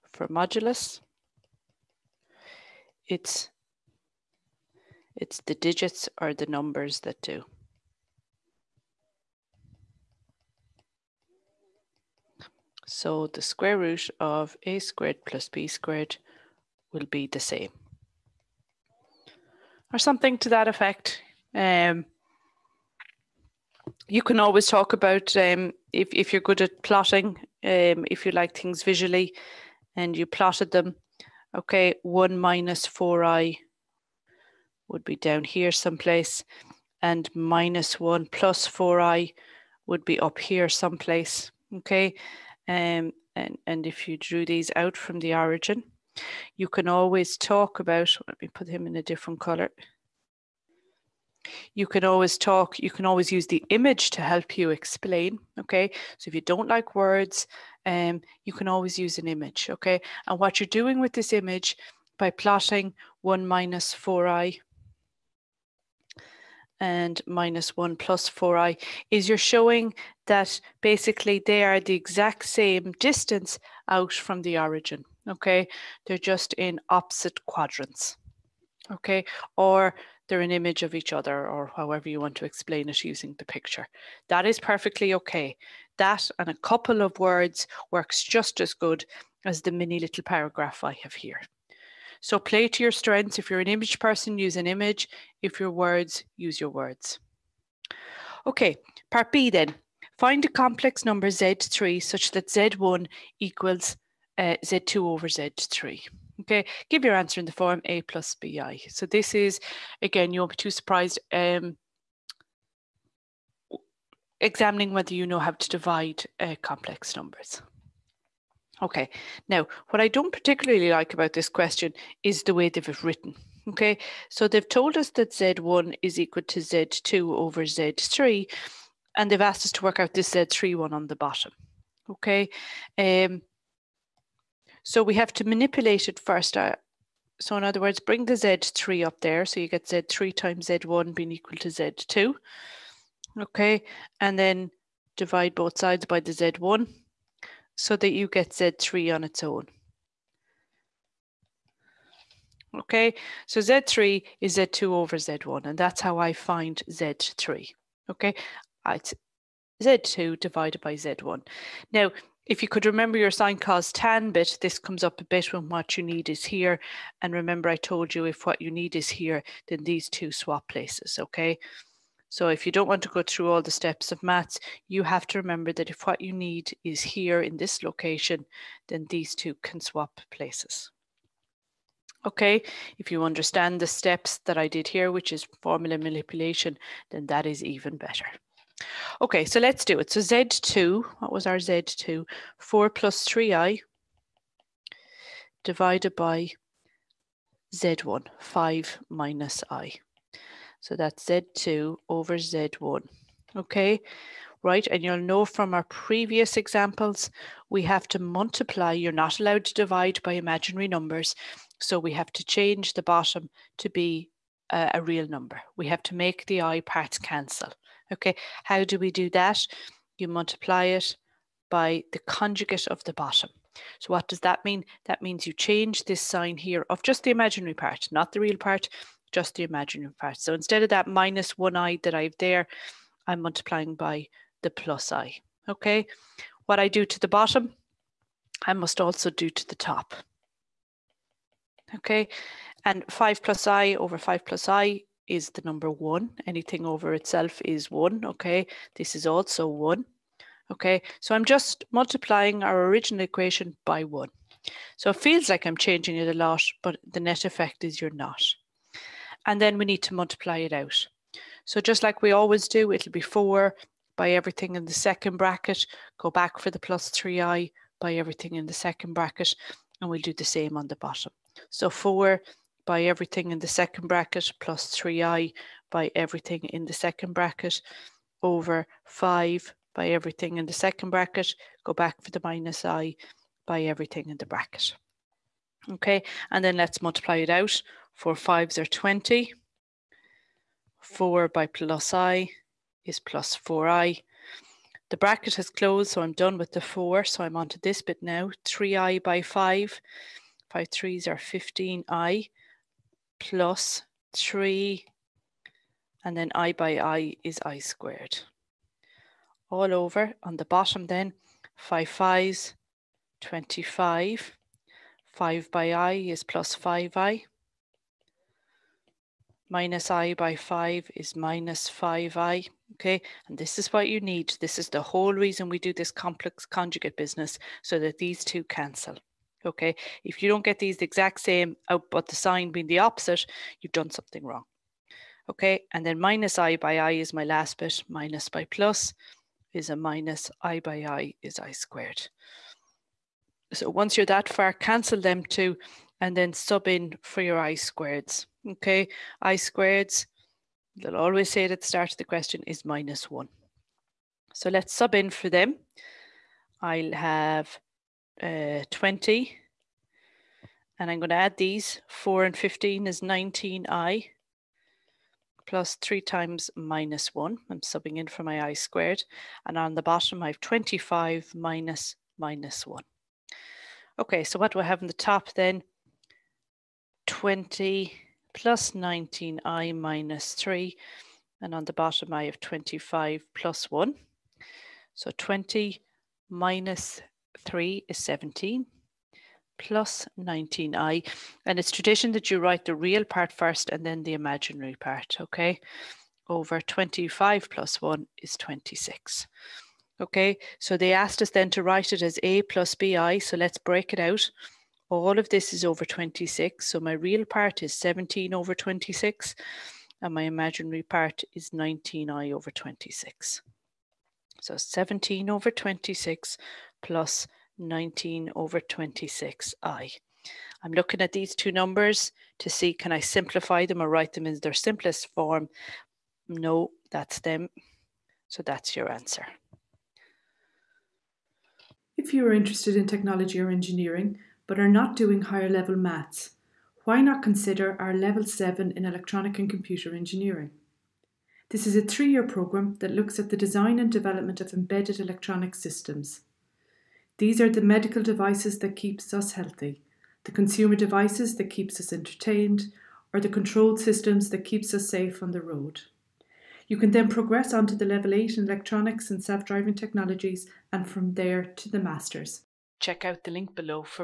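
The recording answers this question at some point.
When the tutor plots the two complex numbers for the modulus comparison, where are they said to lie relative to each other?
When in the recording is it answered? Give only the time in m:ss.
1:16.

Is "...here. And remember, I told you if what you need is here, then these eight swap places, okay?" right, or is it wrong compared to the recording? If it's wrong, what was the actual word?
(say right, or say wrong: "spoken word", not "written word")
wrong: "two", not "eight".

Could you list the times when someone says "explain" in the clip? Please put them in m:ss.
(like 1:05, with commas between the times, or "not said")
0:54, 1:22.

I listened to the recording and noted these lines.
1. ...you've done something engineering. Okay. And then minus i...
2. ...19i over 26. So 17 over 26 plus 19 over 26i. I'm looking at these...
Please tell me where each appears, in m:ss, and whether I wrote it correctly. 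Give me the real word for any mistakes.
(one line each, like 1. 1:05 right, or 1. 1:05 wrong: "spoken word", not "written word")
1. 5:33 wrong: "wrong", not "engineering"
2. 6:51 right.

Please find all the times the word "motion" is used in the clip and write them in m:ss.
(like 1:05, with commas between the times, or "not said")
not said.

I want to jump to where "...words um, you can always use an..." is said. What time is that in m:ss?
0:56.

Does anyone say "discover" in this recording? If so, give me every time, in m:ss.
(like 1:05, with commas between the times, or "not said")
not said.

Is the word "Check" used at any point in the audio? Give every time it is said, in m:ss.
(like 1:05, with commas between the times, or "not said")
7:42.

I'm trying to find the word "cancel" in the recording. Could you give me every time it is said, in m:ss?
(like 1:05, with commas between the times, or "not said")
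3:37, 5:28, 5:44.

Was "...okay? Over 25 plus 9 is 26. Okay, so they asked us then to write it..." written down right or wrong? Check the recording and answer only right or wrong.
wrong.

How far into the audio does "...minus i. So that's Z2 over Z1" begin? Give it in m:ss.
3:19.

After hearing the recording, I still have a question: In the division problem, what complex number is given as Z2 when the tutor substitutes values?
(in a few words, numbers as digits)
4 + 3i.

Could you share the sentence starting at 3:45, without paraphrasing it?
That means you change this sign here of just the imaginary part, not the real part, just the imaginary part.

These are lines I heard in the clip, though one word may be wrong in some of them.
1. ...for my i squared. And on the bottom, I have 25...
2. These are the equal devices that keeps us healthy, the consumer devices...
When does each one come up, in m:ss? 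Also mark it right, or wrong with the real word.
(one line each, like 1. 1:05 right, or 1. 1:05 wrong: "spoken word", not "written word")
1. 6:08 right
2. 7:27 wrong: "medical", not "equal".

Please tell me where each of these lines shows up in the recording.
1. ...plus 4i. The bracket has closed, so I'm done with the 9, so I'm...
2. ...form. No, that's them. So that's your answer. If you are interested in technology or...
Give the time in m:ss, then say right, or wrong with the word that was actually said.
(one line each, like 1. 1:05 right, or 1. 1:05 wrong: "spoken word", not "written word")
1. 4:53 wrong: "4", not "9"
2. 7:05 right.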